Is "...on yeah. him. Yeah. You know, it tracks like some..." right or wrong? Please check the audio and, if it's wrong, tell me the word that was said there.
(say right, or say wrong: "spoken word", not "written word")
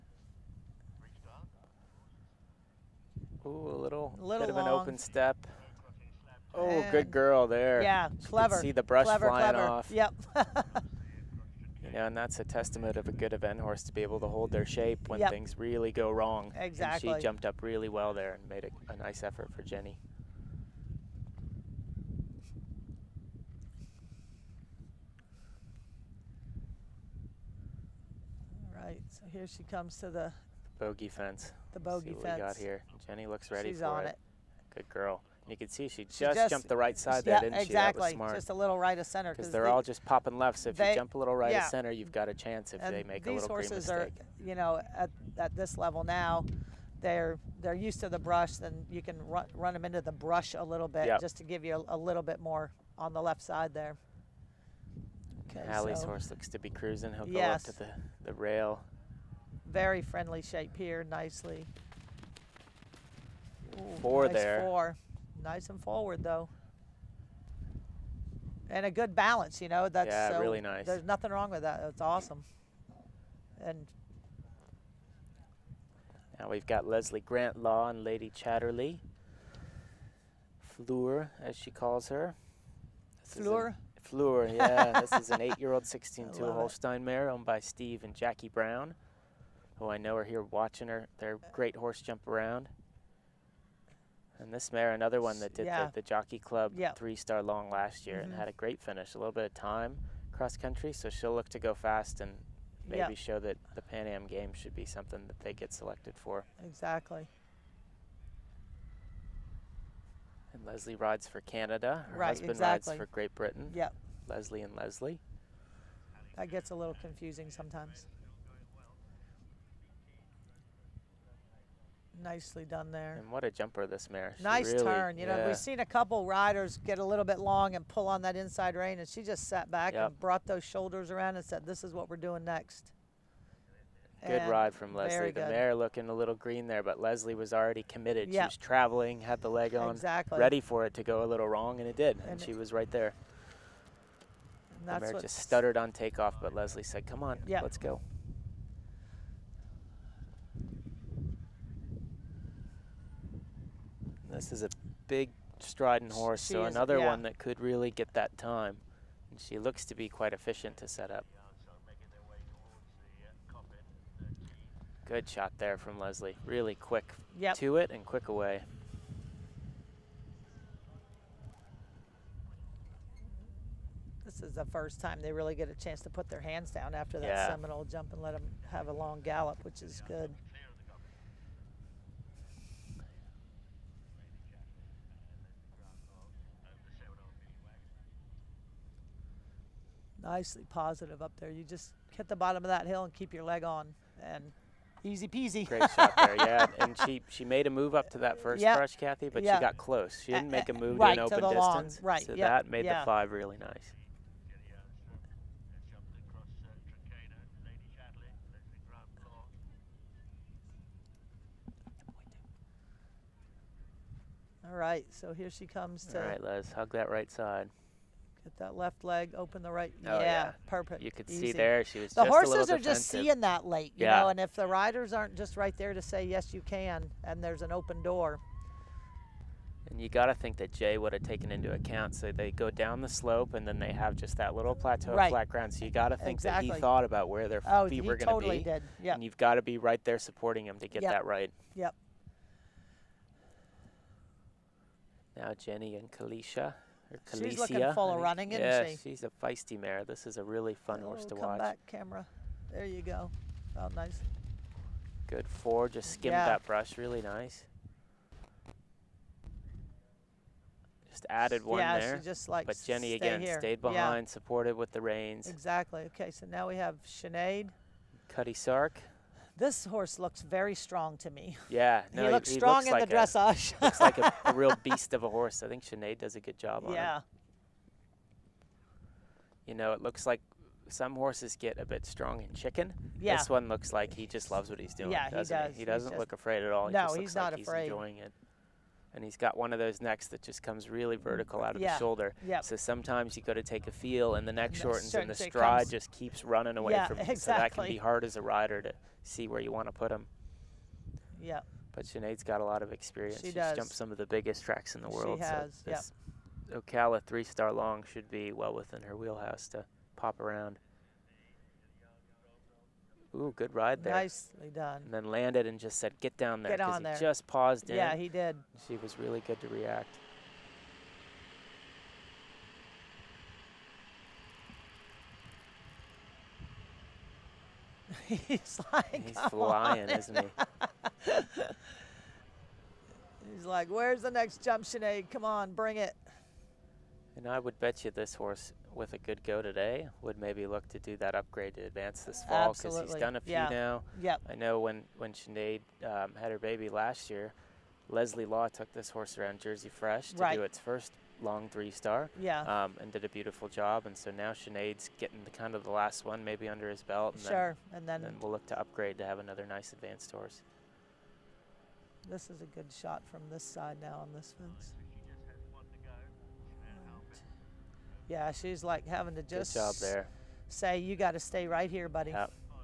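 wrong: "looks", not "tracks".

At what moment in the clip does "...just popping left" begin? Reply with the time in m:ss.
0:39.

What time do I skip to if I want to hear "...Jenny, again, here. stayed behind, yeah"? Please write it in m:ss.
4:22.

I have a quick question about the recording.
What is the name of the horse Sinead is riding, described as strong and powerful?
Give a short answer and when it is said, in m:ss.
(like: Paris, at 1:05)
Cutty Sark, at 4:28.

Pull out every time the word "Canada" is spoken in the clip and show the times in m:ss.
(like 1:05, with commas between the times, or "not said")
1:51.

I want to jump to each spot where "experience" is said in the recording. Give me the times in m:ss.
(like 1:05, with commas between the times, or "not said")
5:02.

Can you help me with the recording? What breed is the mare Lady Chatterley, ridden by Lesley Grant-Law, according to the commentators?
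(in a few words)
Holstein.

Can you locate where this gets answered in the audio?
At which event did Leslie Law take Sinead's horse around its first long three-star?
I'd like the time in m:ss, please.
5:49.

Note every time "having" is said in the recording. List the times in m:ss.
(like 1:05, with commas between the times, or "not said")
6:09.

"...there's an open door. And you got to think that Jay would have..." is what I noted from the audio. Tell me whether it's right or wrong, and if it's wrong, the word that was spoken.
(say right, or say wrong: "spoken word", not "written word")
right.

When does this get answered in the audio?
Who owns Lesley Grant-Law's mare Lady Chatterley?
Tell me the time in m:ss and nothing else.
1:27.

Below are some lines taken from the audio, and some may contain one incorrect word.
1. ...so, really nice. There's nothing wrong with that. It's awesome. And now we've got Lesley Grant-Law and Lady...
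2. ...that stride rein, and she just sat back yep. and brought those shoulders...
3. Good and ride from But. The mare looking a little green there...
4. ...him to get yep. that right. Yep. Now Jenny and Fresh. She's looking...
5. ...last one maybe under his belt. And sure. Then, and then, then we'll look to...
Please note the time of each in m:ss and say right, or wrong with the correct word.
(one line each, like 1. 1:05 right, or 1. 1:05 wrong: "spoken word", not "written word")
1. 1:10 right
2. 2:08 wrong: "inside", not "stride"
3. 2:14 wrong: "Lesley", not "But"
4. 4:00 wrong: "Kalisha", not "Fresh"
5. 5:55 right.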